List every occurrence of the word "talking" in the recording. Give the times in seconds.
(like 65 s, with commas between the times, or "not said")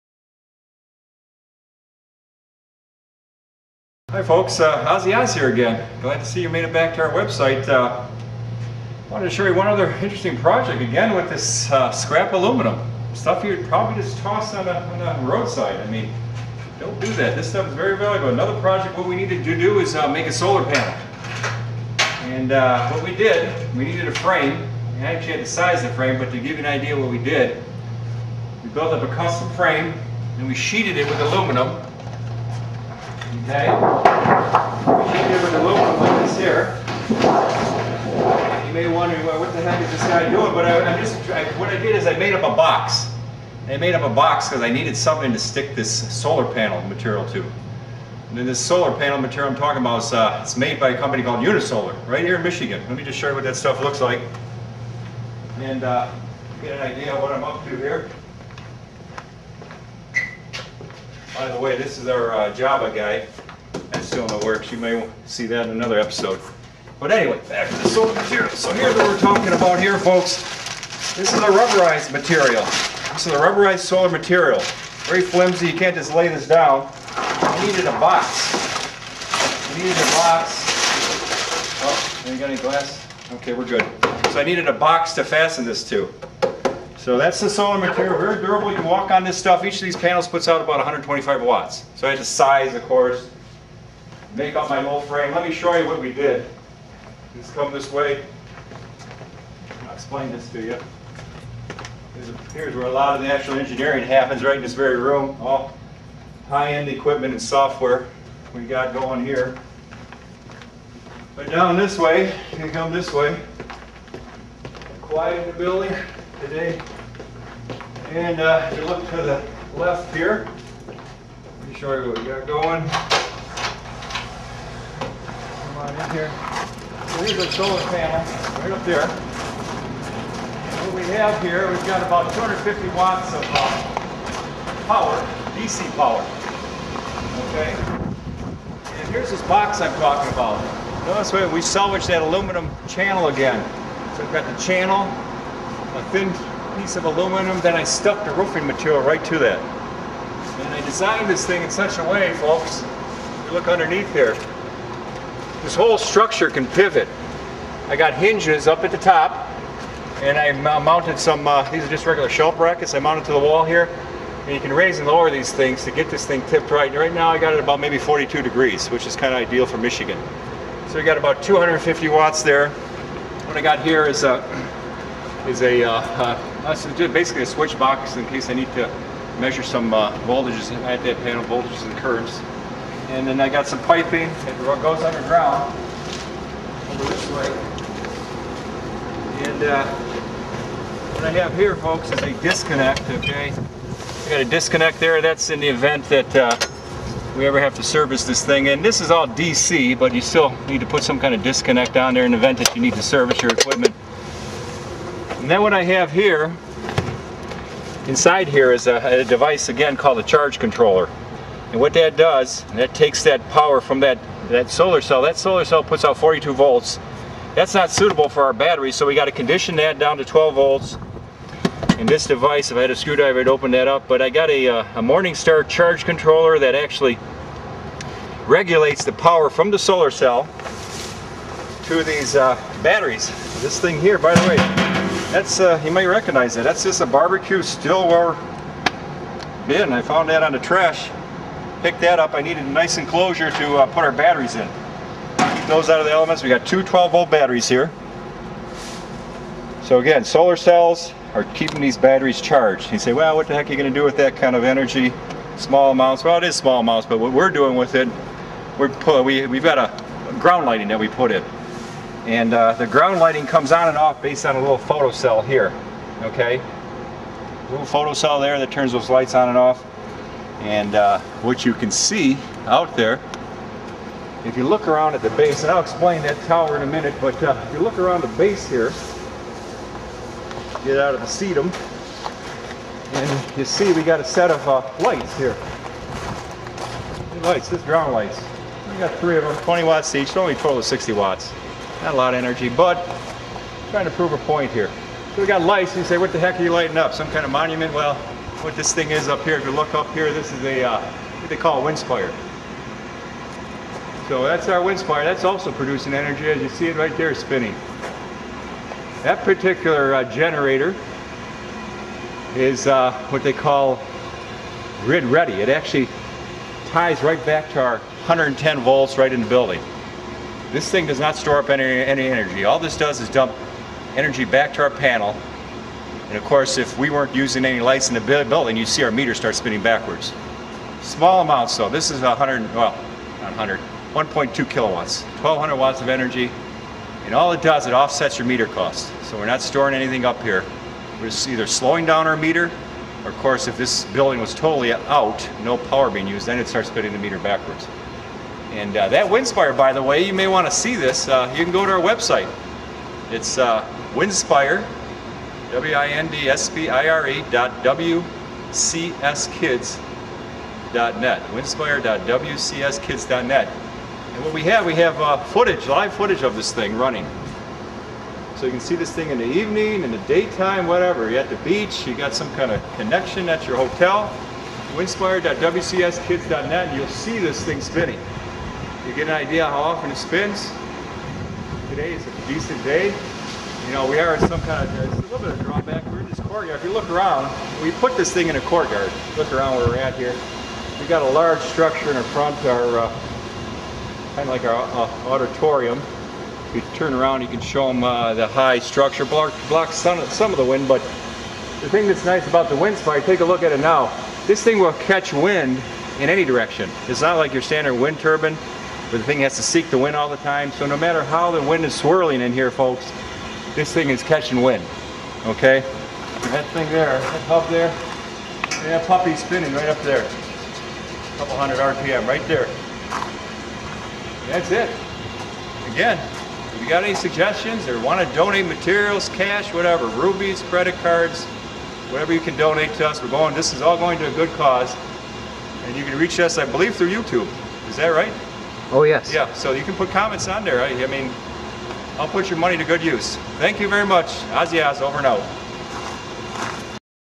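49 s, 69 s, 140 s.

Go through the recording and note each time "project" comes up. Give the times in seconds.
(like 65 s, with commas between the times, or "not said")
10 s, 18 s.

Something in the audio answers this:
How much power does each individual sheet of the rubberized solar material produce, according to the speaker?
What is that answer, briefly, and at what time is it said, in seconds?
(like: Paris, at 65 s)
125 watts, at 90 s.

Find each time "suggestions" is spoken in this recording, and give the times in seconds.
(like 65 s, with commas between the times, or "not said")
427 s.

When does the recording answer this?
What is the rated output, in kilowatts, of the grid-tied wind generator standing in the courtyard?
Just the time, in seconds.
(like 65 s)
334 s.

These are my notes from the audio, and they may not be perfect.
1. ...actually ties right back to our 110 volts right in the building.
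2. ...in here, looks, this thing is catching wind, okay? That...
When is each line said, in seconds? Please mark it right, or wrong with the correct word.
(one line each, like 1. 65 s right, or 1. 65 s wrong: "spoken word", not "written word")
1. 315 s right
2. 412 s wrong: "folks", not "looks".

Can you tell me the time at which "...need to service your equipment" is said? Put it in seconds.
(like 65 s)
202 s.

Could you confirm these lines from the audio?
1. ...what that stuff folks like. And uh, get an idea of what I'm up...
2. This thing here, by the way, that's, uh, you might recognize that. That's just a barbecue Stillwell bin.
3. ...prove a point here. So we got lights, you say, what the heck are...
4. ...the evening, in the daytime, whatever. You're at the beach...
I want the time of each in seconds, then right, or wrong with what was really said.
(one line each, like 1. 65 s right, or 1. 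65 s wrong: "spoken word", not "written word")
1. 53 s wrong: "looks", not "folks"
2. 233 s right
3. 294 s right
4. 369 s right.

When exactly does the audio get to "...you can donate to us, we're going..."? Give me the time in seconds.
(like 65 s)
432 s.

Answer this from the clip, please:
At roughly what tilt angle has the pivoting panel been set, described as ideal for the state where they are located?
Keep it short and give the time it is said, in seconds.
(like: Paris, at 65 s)
42 degrees, at 167 s.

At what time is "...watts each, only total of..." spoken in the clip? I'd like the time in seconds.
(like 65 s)
289 s.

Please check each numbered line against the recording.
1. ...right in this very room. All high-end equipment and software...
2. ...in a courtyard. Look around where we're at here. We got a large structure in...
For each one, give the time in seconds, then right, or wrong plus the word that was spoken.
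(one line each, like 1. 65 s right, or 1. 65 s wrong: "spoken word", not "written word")
1. 104 s right
2. 388 s right.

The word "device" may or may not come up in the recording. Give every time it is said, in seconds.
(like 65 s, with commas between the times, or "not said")
209 s, 222 s.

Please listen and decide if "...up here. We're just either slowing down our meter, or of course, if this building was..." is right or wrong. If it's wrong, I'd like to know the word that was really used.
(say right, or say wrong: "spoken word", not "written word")
right.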